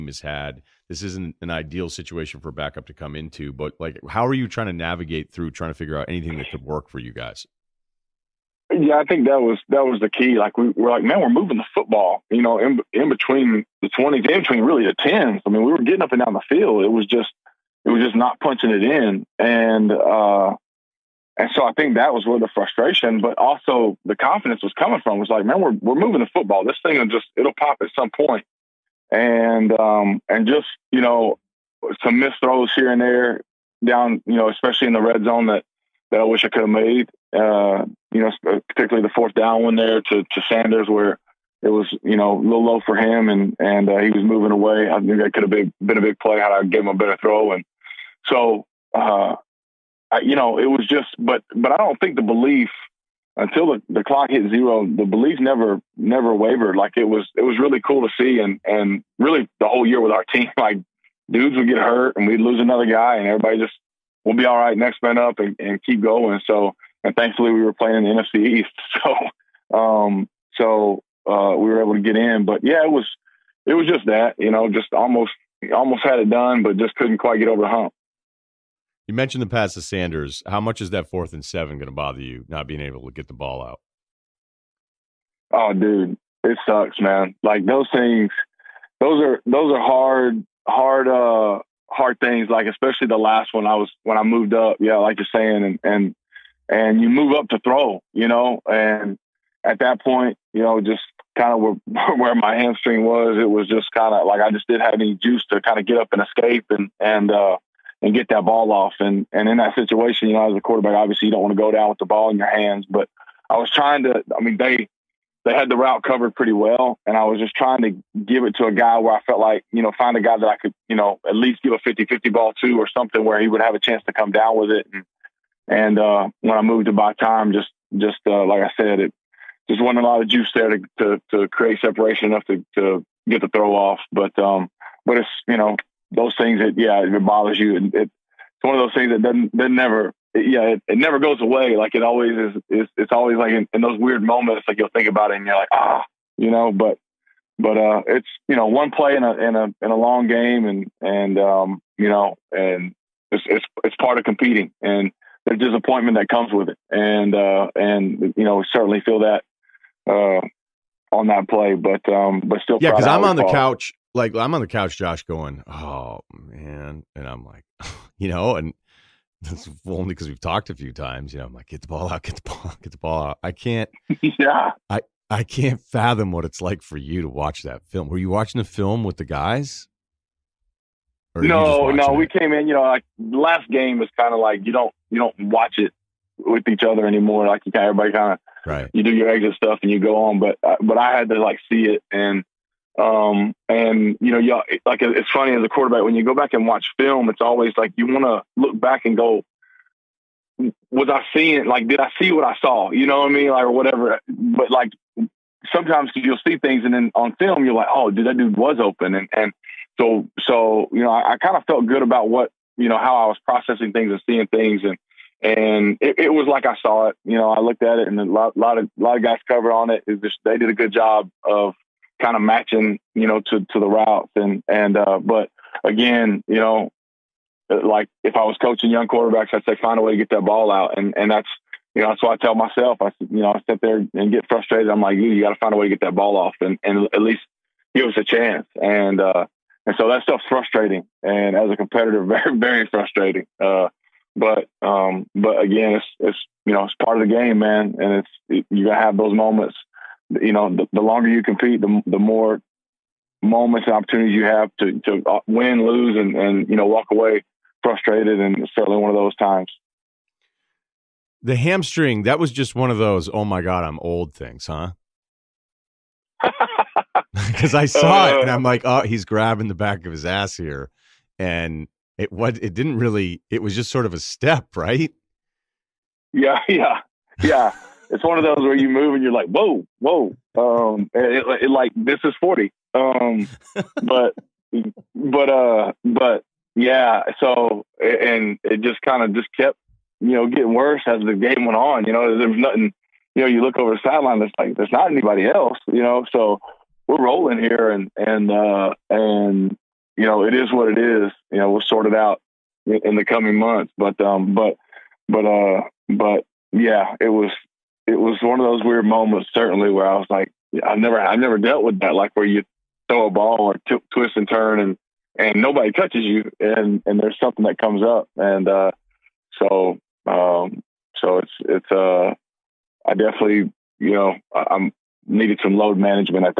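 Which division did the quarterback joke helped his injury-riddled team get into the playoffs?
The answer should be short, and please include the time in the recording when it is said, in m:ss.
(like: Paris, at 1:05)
NFC East, at 1:08.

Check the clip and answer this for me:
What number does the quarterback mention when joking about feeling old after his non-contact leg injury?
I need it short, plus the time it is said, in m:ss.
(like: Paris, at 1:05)
40, at 4:42.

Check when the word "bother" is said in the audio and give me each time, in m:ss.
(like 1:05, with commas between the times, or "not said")
1:21, 2:17.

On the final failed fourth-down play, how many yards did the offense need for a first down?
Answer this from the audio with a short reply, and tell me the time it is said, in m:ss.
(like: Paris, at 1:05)
7, at 1:21.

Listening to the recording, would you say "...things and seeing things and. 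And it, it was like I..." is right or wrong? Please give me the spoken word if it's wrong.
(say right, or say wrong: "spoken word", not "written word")
right.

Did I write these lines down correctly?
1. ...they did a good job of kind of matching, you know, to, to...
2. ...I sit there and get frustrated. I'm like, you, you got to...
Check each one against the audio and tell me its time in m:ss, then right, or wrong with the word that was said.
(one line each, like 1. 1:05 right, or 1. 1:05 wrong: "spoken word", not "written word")
1. 3:40 right
2. 3:53 right.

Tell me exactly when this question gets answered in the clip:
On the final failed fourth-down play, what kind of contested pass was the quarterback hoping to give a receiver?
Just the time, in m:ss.
2:01.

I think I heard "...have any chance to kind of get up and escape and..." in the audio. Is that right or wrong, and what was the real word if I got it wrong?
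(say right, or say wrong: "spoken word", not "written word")
wrong: "juice", not "chance".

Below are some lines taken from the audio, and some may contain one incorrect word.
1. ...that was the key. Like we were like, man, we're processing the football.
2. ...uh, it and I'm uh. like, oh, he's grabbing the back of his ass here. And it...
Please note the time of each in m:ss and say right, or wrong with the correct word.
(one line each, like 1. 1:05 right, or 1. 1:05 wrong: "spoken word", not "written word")
1. 0:09 wrong: "moving", not "processing"
2. 4:28 right.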